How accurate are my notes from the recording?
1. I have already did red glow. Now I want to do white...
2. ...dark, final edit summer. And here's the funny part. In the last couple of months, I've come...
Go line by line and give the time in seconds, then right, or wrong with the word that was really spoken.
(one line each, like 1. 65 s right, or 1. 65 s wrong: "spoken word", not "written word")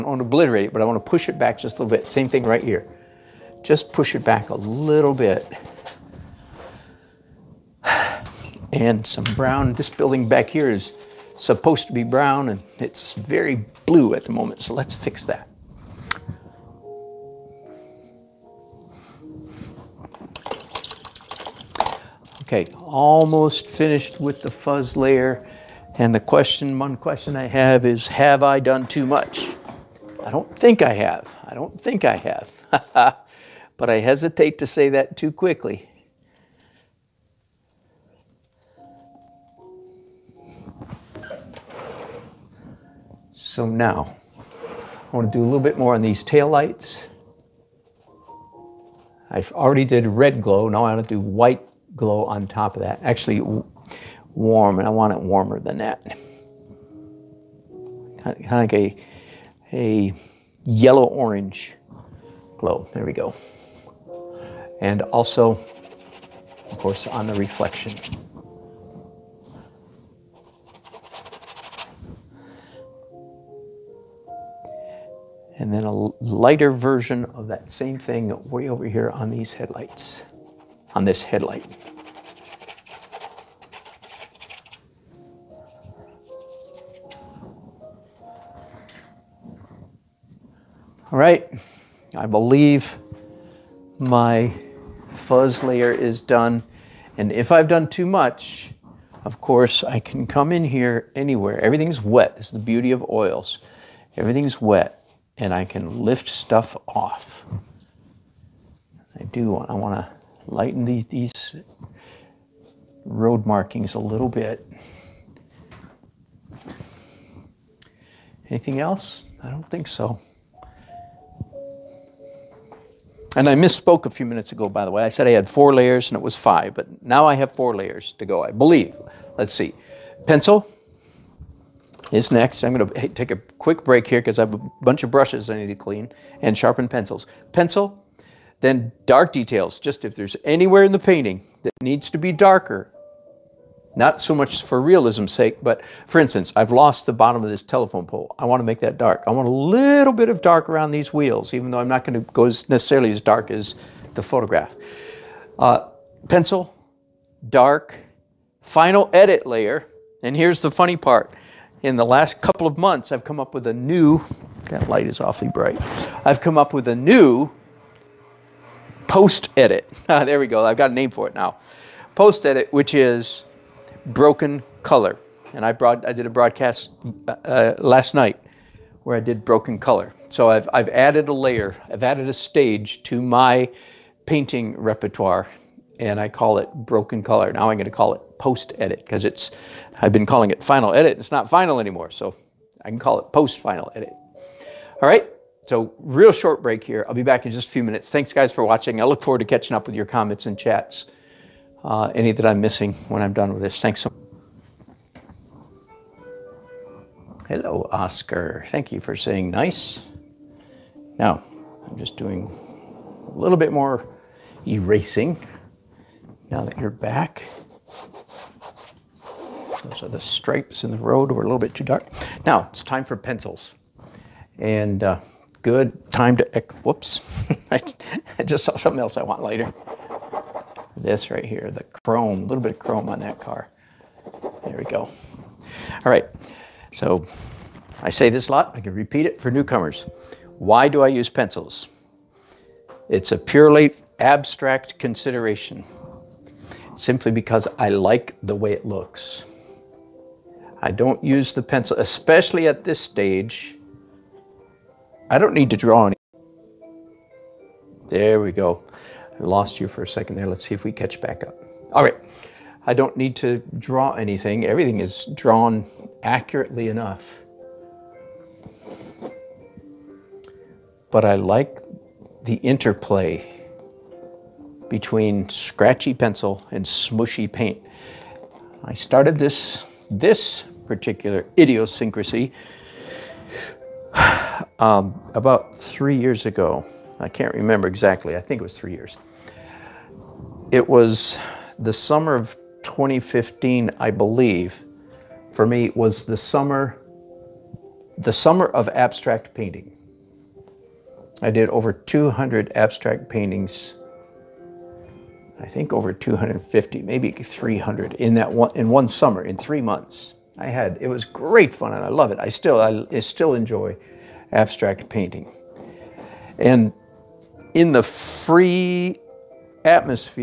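1. 49 s right
2. 157 s wrong: "layer", not "summer".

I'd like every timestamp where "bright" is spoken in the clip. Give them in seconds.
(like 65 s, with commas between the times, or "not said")
165 s.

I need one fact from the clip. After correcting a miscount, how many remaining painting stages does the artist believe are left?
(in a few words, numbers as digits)
4.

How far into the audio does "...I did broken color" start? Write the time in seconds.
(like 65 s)
179 s.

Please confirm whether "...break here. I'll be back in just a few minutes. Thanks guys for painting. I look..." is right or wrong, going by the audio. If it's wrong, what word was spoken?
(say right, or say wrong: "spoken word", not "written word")
wrong: "watching", not "painting".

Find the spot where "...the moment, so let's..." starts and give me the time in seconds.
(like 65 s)
14 s.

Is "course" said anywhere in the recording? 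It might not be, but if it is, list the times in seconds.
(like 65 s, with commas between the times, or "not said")
66 s, 99 s.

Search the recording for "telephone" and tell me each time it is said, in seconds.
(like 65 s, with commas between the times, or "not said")
147 s.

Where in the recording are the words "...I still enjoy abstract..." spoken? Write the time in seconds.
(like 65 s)
313 s.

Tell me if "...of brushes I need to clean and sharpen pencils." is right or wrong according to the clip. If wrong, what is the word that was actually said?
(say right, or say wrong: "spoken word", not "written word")
right.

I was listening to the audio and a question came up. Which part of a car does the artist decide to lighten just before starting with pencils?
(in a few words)
The chrome.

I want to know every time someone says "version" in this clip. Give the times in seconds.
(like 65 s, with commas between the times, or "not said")
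76 s.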